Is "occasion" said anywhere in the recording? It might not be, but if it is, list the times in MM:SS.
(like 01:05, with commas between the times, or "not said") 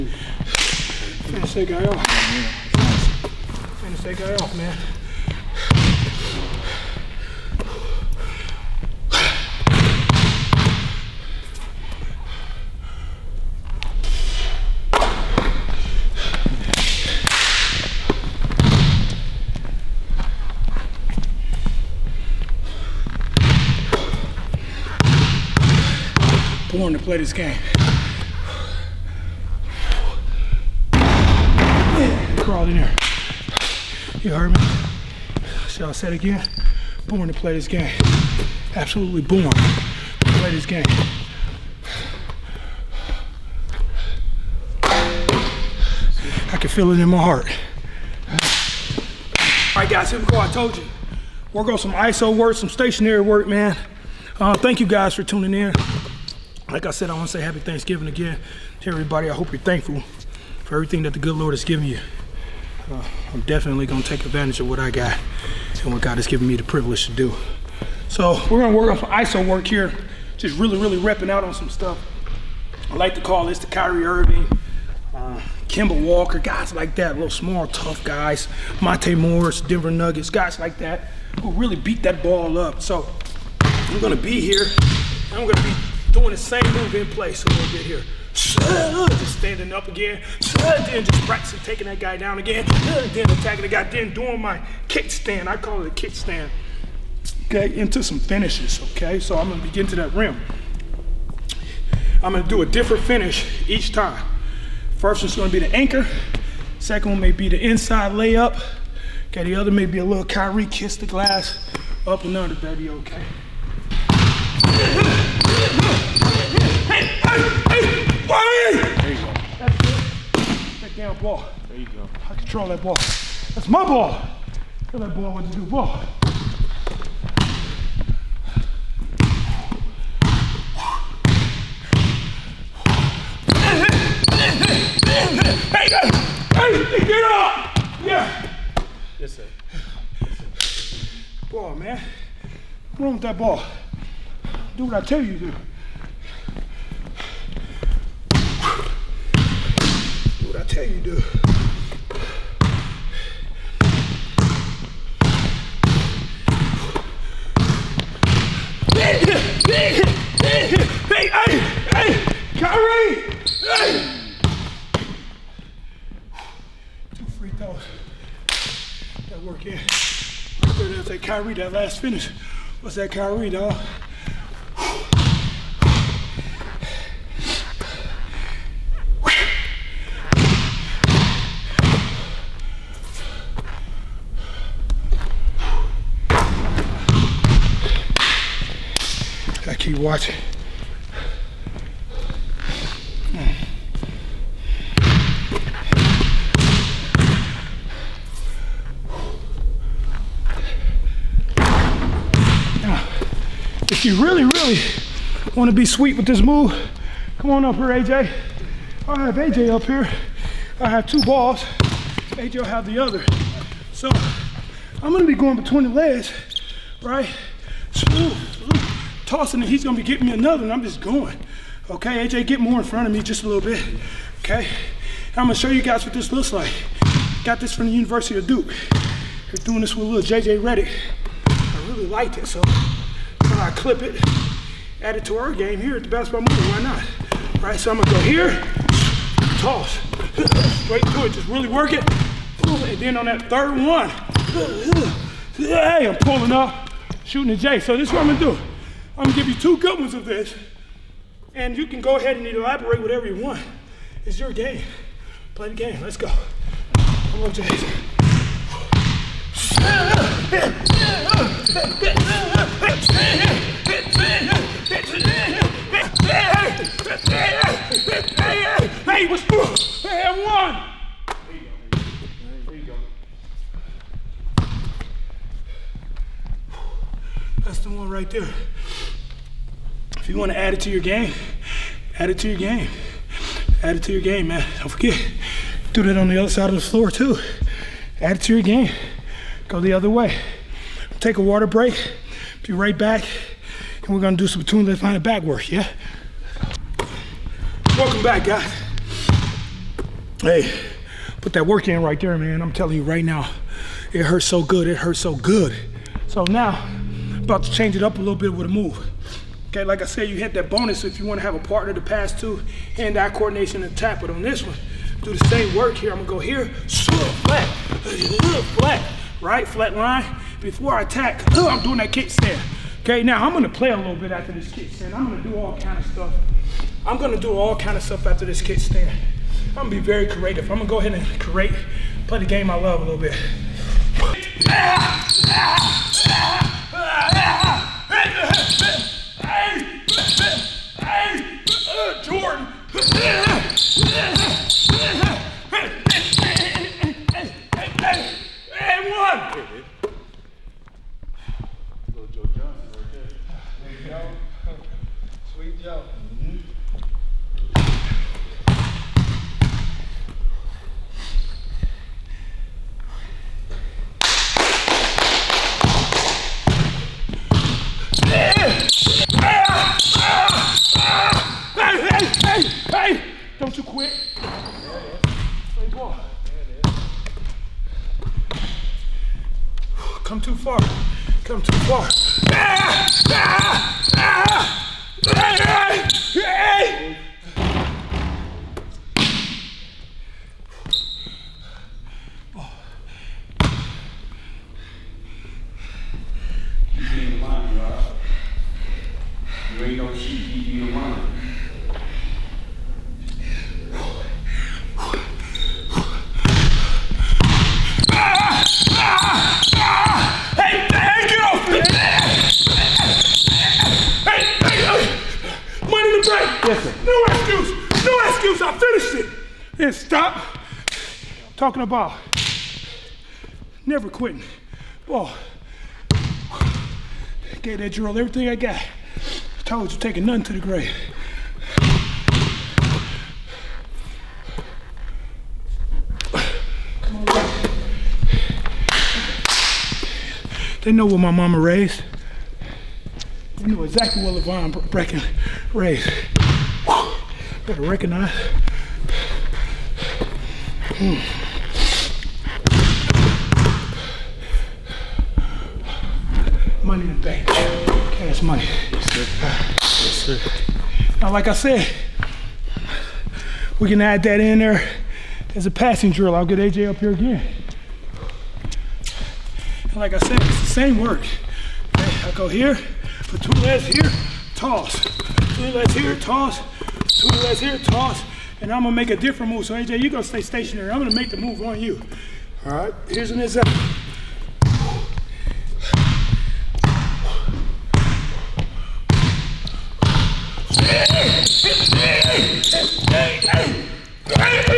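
not said.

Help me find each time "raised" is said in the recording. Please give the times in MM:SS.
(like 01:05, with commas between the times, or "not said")
07:21, 07:25.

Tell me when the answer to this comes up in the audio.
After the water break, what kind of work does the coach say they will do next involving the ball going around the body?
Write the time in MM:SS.
04:54.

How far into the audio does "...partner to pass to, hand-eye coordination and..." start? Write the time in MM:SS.
05:11.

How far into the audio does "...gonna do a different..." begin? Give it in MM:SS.
01:42.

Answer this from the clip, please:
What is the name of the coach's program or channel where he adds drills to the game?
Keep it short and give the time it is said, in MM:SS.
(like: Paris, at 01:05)
the Basketball Movement, at 03:56.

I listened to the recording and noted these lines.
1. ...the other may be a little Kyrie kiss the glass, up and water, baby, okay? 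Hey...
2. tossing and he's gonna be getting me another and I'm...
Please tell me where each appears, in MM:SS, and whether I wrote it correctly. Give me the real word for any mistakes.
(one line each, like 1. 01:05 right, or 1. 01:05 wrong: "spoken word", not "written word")
1. 01:49 wrong: "under", not "water"
2. 03:39 right.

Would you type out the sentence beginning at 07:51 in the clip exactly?
I go here, put two legs here, toss.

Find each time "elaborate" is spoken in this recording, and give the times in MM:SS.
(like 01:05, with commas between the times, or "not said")
04:12.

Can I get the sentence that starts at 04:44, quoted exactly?
Don't forget, do that on the other side of the floor too.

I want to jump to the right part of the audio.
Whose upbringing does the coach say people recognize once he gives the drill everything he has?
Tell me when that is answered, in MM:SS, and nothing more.
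07:24.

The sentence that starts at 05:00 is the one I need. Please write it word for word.
Hey, put that work in right there, man.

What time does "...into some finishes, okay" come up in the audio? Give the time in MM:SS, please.
01:37.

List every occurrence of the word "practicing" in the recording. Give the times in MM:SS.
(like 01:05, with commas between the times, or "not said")
01:31.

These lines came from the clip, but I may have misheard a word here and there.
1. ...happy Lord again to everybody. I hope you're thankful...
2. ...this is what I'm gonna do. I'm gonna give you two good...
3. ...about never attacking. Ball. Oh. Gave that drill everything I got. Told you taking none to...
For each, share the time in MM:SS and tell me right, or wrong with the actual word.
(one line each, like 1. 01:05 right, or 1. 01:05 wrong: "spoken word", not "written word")
1. 00:57 wrong: "Thanksgiving", not "Lord"
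2. 04:07 right
3. 07:01 wrong: "quitting", not "attacking".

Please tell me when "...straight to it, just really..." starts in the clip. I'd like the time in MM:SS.
04:00.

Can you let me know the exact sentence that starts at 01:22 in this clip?
So I'm going to be here.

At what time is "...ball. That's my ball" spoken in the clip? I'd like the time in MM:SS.
02:02.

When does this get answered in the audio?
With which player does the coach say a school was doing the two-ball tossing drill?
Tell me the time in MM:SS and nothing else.
03:50.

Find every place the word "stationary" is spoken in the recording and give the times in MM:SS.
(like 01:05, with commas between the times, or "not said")
00:52, 08:00.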